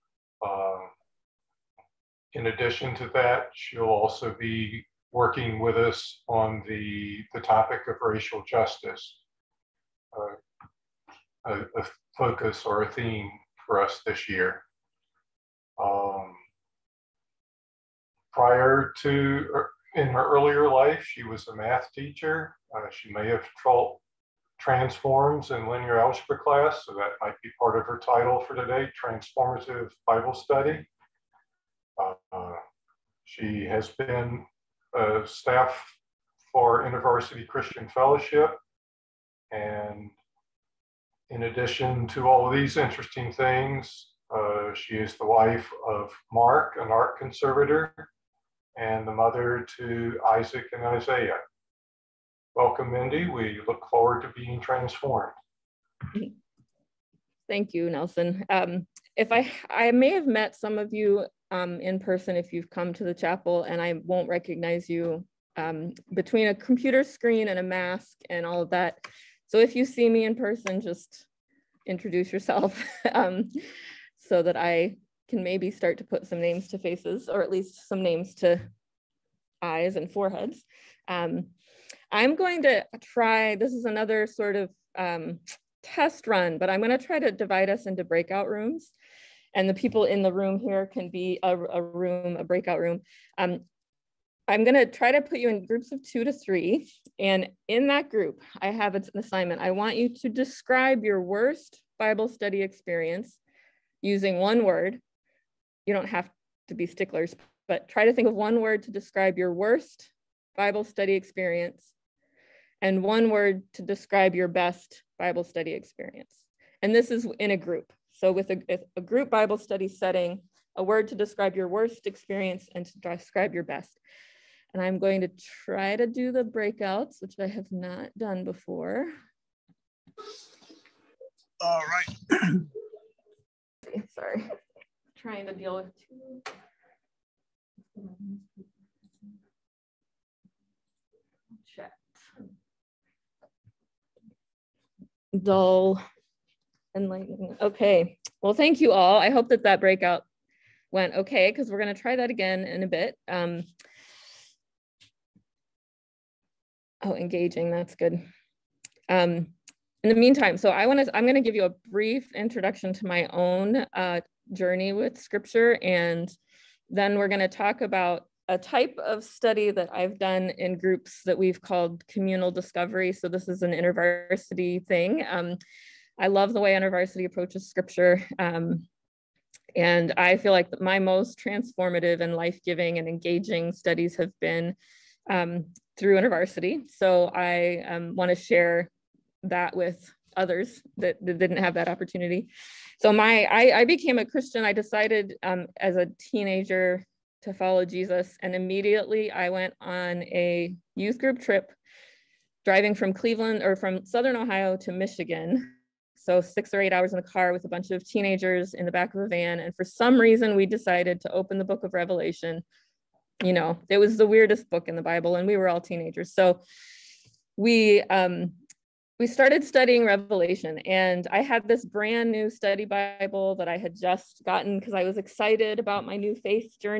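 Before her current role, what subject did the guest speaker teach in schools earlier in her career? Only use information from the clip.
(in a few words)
Math.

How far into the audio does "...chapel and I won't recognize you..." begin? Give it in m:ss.
1:03.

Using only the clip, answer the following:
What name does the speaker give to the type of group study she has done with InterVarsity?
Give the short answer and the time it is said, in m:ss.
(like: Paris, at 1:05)
Communal discovery, at 2:52.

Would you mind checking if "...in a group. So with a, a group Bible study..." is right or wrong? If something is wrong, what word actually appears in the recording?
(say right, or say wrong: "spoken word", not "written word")
right.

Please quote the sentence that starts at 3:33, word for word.
You know, it was the weirdest book in the Bible, and we were all teenagers.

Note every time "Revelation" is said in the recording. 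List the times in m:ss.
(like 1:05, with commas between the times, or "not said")
3:31, 3:40.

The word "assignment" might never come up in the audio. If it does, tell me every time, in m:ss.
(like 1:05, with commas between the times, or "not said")
1:39.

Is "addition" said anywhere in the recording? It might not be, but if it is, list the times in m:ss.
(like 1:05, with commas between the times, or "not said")
0:02, 0:41.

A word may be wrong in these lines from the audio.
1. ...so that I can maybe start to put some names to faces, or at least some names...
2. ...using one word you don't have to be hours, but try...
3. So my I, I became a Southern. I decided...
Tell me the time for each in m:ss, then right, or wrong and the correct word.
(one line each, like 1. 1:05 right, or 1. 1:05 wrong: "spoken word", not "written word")
1. 1:14 right
2. 1:44 wrong: "sticklers", not "hours"
3. 3:13 wrong: "Christian", not "Southern".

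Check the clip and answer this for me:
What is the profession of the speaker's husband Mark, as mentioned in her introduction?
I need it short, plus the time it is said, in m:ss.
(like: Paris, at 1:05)
Art conservator, at 0:46.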